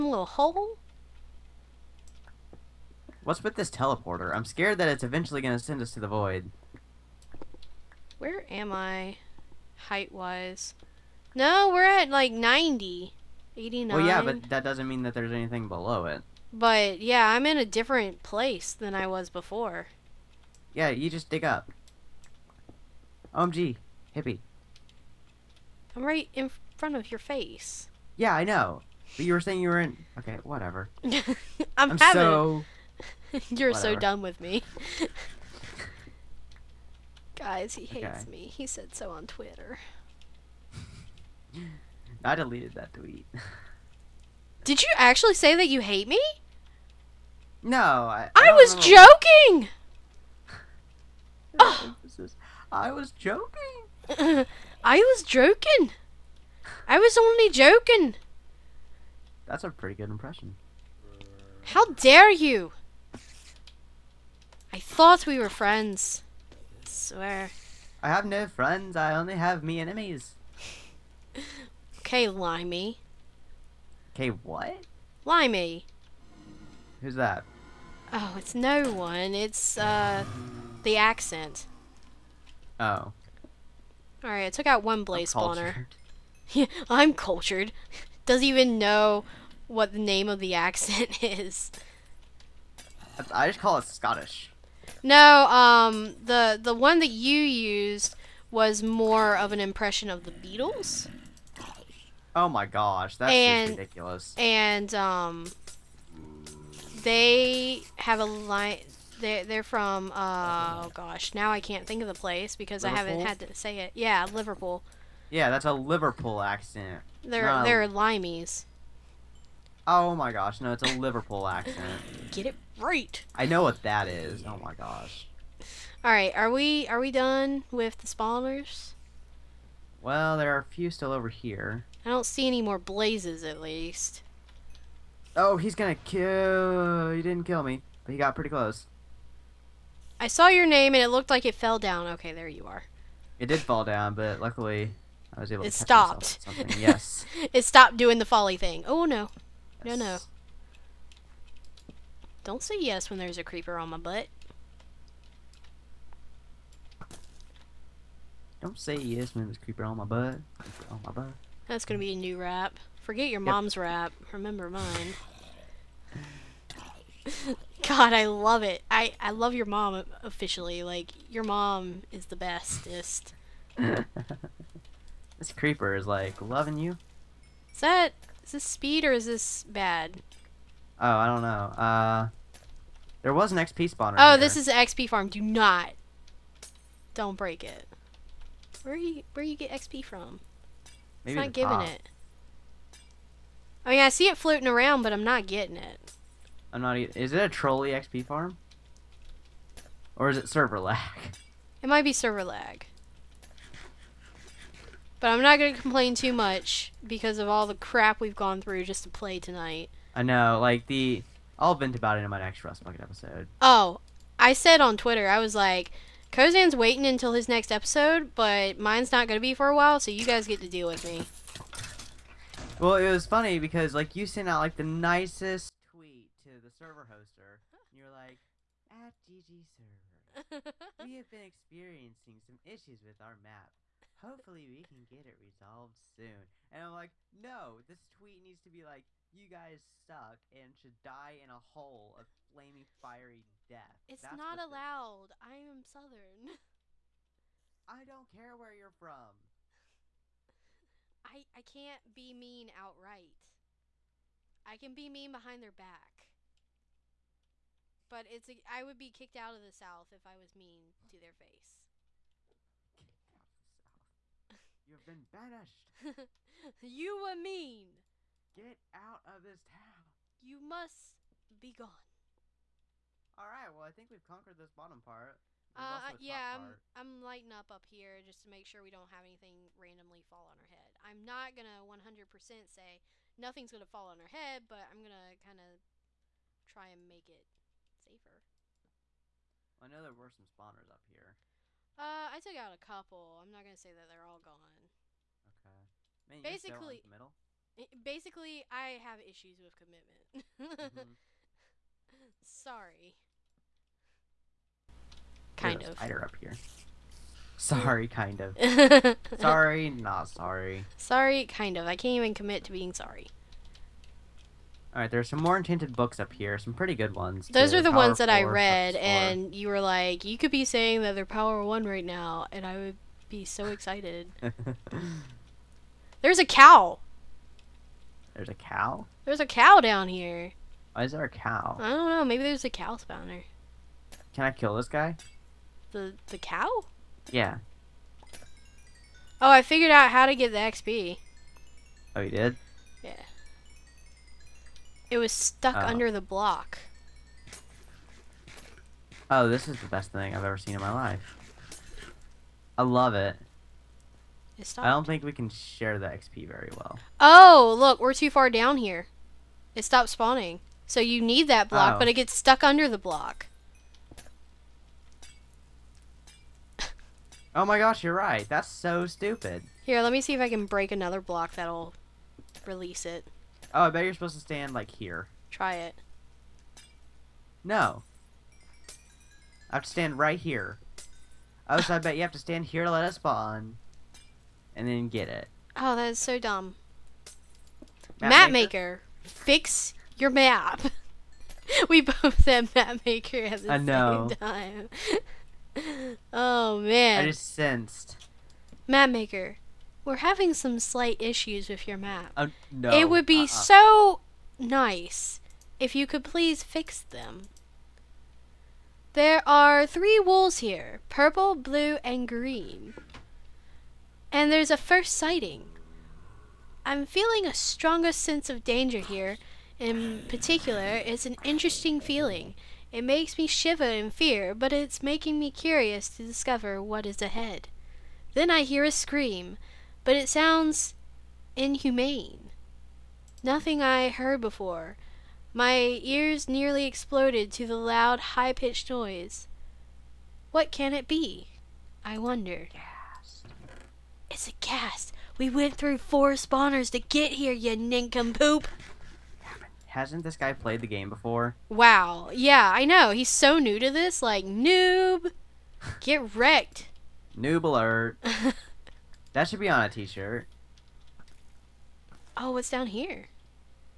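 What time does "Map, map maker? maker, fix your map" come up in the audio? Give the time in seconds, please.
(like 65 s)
388 s.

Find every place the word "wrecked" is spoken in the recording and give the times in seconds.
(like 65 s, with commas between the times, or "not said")
456 s.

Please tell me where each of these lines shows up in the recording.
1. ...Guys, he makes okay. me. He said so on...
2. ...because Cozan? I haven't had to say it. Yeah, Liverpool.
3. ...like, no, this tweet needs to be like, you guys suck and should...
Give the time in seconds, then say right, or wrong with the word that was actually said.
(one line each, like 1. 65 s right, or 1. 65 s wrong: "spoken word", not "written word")
1. 37 s wrong: "hates", not "makes"
2. 112 s wrong: "Liverpool", not "Cozan"
3. 236 s right.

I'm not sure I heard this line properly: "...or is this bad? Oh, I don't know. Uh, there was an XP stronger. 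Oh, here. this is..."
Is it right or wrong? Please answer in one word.
wrong.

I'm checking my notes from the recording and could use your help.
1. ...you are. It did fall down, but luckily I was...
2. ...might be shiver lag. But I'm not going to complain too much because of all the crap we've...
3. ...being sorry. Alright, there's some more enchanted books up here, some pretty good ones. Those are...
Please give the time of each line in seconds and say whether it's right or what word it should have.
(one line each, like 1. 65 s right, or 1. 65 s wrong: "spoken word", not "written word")
1. 142 s right
2. 201 s wrong: "server", not "shiver"
3. 312 s right.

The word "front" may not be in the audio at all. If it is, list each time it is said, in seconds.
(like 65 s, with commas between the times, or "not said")
26 s.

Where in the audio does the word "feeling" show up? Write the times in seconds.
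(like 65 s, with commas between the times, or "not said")
417 s, 422 s.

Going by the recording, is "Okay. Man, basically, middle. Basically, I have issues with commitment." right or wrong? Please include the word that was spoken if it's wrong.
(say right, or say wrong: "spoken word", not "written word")
right.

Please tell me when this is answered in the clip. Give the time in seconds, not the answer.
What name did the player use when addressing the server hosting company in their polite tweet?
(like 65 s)
229 s.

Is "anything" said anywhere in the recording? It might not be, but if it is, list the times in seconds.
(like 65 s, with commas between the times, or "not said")
15 s, 279 s.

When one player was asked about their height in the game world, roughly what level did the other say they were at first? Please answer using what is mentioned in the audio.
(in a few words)
90.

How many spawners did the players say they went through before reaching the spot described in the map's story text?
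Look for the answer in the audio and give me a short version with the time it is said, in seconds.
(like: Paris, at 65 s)
4, at 445 s.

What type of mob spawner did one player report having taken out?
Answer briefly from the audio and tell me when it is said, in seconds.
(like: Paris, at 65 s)
Blaze spawner, at 85 s.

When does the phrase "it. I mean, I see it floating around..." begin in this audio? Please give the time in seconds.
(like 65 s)
191 s.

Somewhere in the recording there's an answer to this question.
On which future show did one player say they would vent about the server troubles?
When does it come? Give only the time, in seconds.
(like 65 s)
212 s.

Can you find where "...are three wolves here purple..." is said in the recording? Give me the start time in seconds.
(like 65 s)
409 s.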